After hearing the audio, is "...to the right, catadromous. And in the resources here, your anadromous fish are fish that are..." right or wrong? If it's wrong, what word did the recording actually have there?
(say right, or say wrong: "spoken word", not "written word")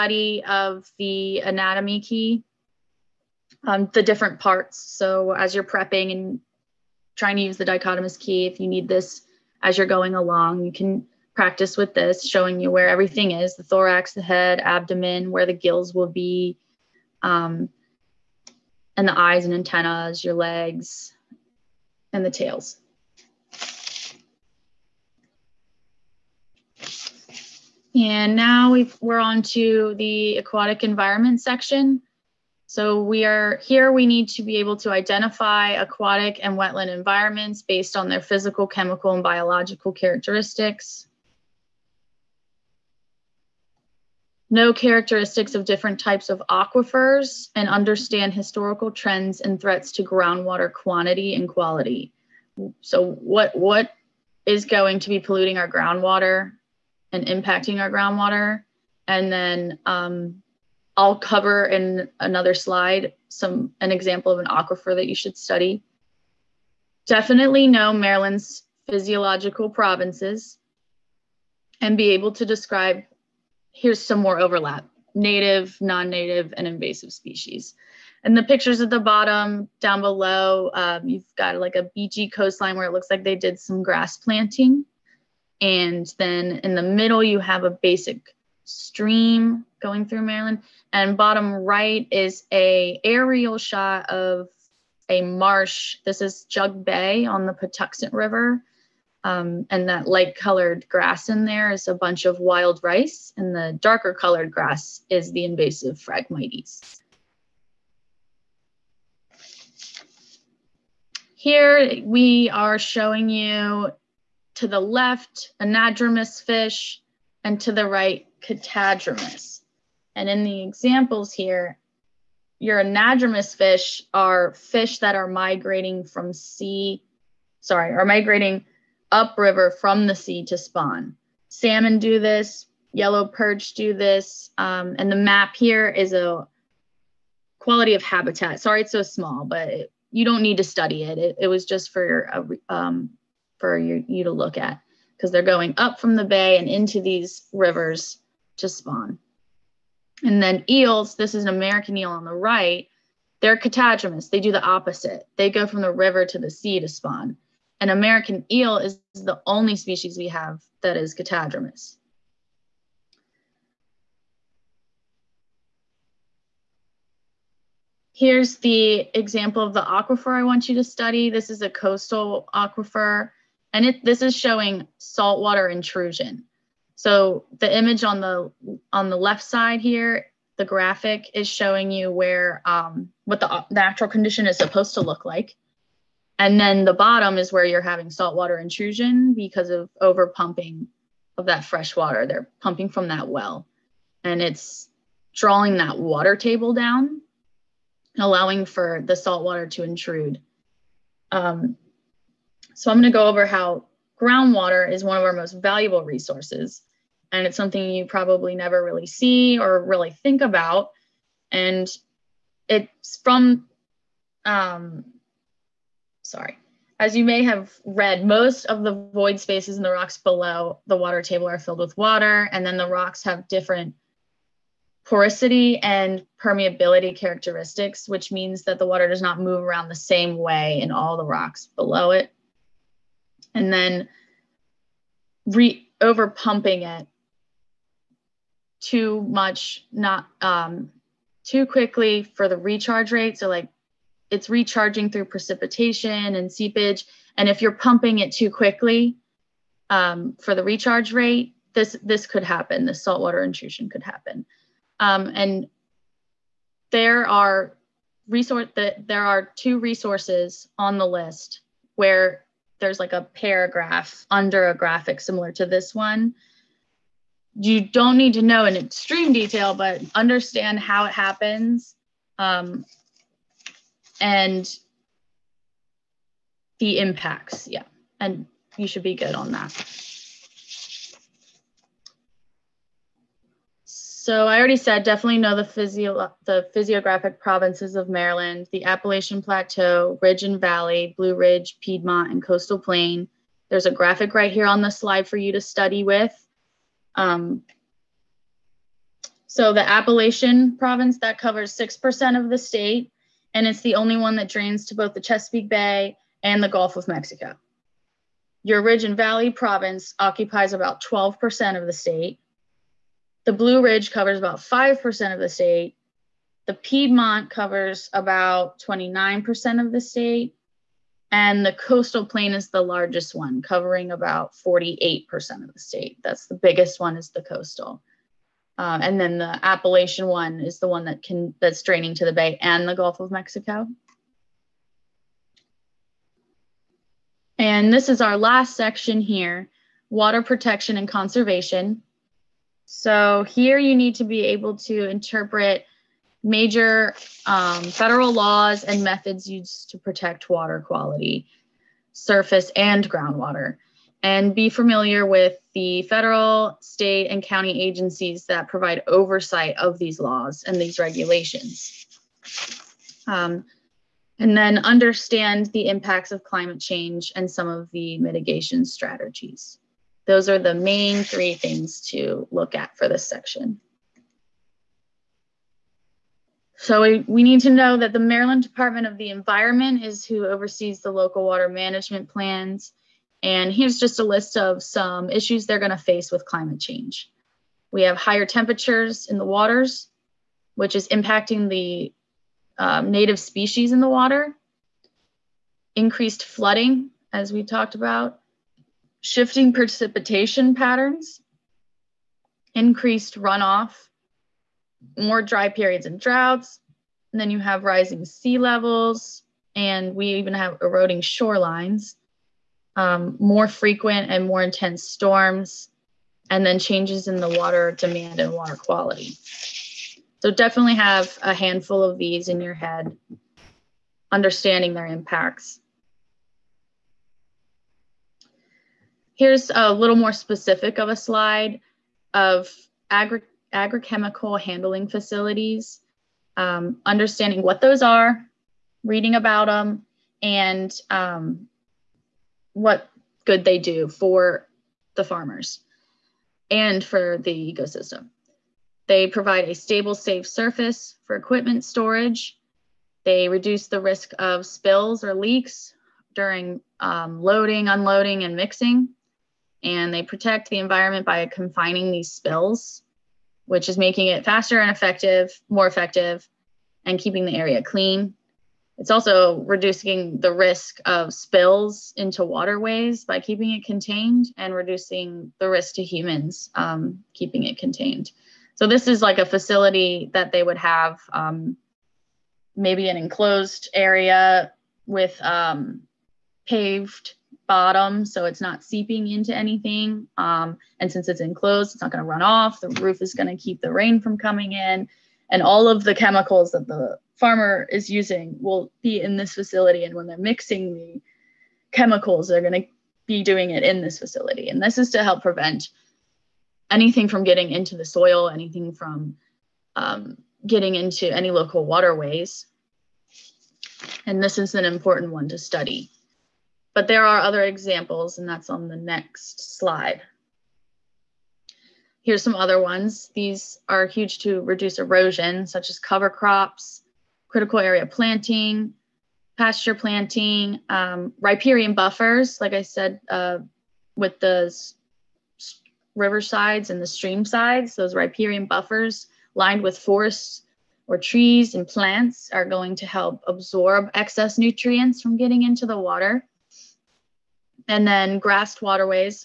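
wrong: "examples", not "resources".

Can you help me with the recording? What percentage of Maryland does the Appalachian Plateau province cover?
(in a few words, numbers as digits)
6%.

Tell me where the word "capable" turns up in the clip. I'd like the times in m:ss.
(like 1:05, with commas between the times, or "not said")
not said.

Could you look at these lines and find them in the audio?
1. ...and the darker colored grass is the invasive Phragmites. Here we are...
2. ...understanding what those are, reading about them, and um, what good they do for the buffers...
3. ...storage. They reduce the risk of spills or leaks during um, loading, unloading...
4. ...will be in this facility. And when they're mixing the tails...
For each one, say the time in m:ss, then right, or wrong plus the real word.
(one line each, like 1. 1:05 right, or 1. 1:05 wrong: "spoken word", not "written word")
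1. 1:43 right
2. 7:17 wrong: "farmers", not "buffers"
3. 7:31 right
4. 8:18 wrong: "chemicals", not "tails".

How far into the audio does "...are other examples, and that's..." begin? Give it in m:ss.
8:37.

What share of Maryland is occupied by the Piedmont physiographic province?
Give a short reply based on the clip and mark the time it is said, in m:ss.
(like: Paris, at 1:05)
29%, at 5:18.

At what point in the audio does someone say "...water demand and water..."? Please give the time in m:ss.
6:57.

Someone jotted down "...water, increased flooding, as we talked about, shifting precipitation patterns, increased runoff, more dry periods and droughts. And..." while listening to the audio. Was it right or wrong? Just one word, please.
right.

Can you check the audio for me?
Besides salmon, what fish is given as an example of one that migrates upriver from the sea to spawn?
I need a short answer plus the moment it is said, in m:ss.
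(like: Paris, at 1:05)
yellow perch, at 2:12.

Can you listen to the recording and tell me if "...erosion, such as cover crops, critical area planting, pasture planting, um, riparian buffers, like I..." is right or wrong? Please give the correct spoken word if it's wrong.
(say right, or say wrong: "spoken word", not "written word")
right.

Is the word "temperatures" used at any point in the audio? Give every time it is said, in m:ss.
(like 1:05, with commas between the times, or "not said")
6:28.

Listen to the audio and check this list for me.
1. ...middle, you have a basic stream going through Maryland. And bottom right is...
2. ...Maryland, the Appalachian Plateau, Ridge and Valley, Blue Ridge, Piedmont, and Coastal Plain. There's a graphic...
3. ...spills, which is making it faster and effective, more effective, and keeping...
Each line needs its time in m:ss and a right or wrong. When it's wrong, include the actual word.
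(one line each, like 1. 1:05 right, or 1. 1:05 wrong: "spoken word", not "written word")
1. 1:26 right
2. 4:48 right
3. 7:42 right.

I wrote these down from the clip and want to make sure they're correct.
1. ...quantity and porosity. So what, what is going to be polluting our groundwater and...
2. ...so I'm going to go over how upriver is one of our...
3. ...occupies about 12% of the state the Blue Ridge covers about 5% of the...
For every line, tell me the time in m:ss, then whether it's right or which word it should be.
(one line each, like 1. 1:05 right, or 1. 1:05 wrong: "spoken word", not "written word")
1. 0:50 wrong: "quality", not "porosity"
2. 3:22 wrong: "groundwater", not "upriver"
3. 5:10 right.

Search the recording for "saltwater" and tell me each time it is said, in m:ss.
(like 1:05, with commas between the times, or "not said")
2:54, 3:08, 3:19, 4:13.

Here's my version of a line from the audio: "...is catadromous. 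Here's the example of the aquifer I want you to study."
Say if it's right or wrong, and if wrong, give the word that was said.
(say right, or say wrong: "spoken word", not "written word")
right.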